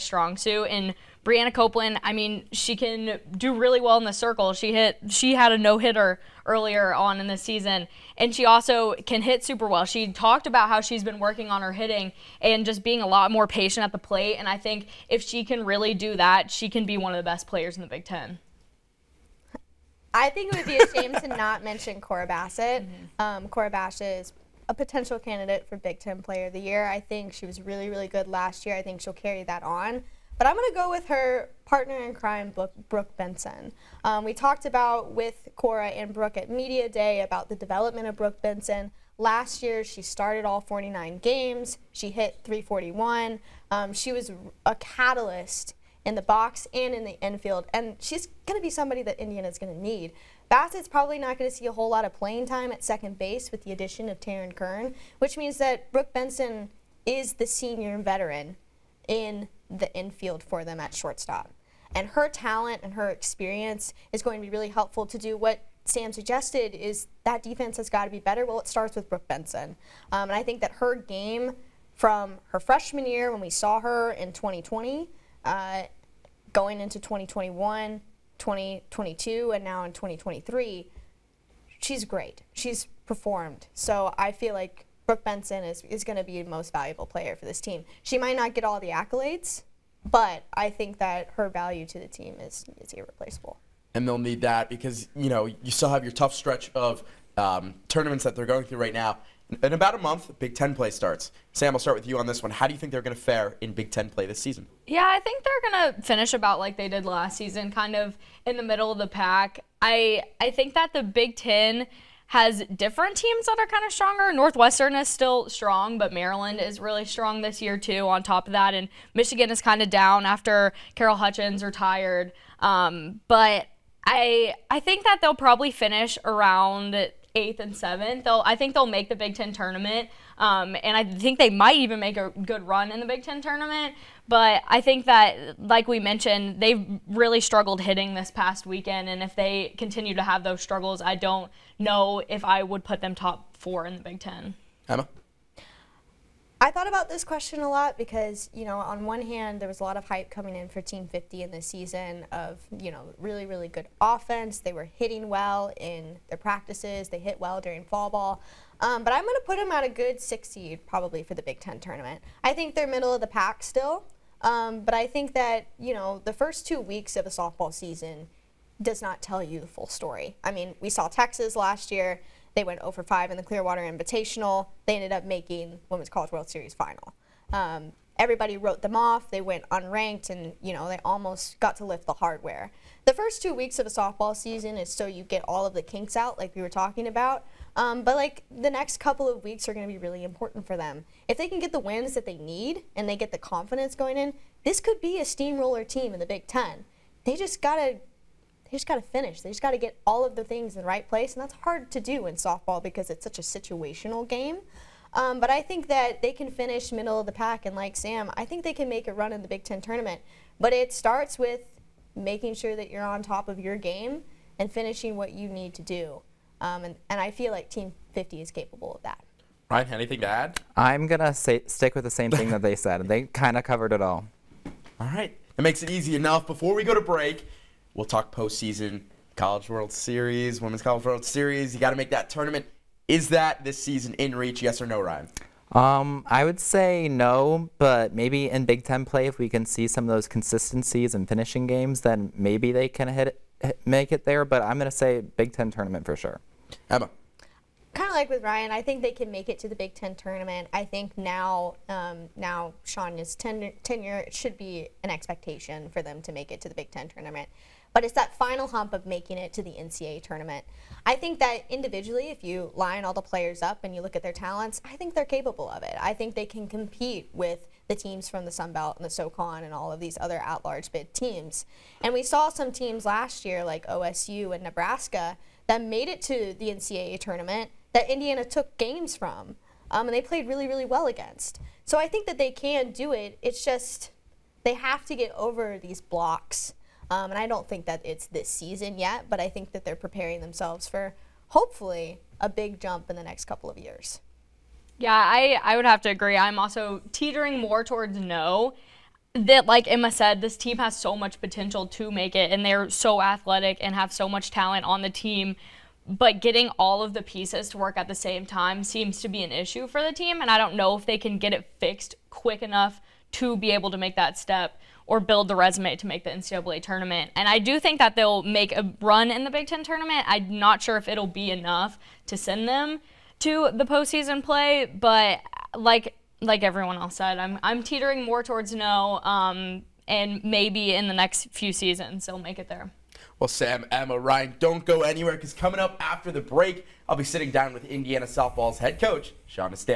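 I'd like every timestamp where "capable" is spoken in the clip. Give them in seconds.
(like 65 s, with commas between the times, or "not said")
218 s, 265 s.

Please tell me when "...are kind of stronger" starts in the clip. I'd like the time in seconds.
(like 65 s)
113 s.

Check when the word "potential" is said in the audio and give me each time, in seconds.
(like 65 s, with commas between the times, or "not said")
24 s, 301 s.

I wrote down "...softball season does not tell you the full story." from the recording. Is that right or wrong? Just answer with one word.
right.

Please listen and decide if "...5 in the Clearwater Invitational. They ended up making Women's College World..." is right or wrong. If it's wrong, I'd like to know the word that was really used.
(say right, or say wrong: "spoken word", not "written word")
right.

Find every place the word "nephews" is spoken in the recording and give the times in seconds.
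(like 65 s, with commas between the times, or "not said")
not said.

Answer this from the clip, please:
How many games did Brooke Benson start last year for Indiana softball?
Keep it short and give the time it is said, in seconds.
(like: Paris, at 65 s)
49, at 40 s.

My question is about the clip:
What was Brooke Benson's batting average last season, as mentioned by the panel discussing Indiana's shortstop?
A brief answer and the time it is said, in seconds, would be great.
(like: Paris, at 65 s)
.341, at 42 s.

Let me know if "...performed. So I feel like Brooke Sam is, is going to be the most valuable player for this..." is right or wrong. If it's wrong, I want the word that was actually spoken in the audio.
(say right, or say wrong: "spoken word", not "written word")
wrong: "Benson", not "Sam".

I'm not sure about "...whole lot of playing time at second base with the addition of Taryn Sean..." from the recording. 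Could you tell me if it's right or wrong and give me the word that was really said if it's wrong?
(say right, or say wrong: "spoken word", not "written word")
wrong: "Kern", not "Sean".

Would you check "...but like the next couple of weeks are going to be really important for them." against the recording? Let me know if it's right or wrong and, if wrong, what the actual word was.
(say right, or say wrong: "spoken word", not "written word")
right.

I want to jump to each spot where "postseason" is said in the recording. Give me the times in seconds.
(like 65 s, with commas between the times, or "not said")
228 s, 323 s.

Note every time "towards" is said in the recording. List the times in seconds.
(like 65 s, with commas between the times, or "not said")
297 s, 328 s.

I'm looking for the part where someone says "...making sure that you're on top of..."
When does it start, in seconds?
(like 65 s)
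212 s.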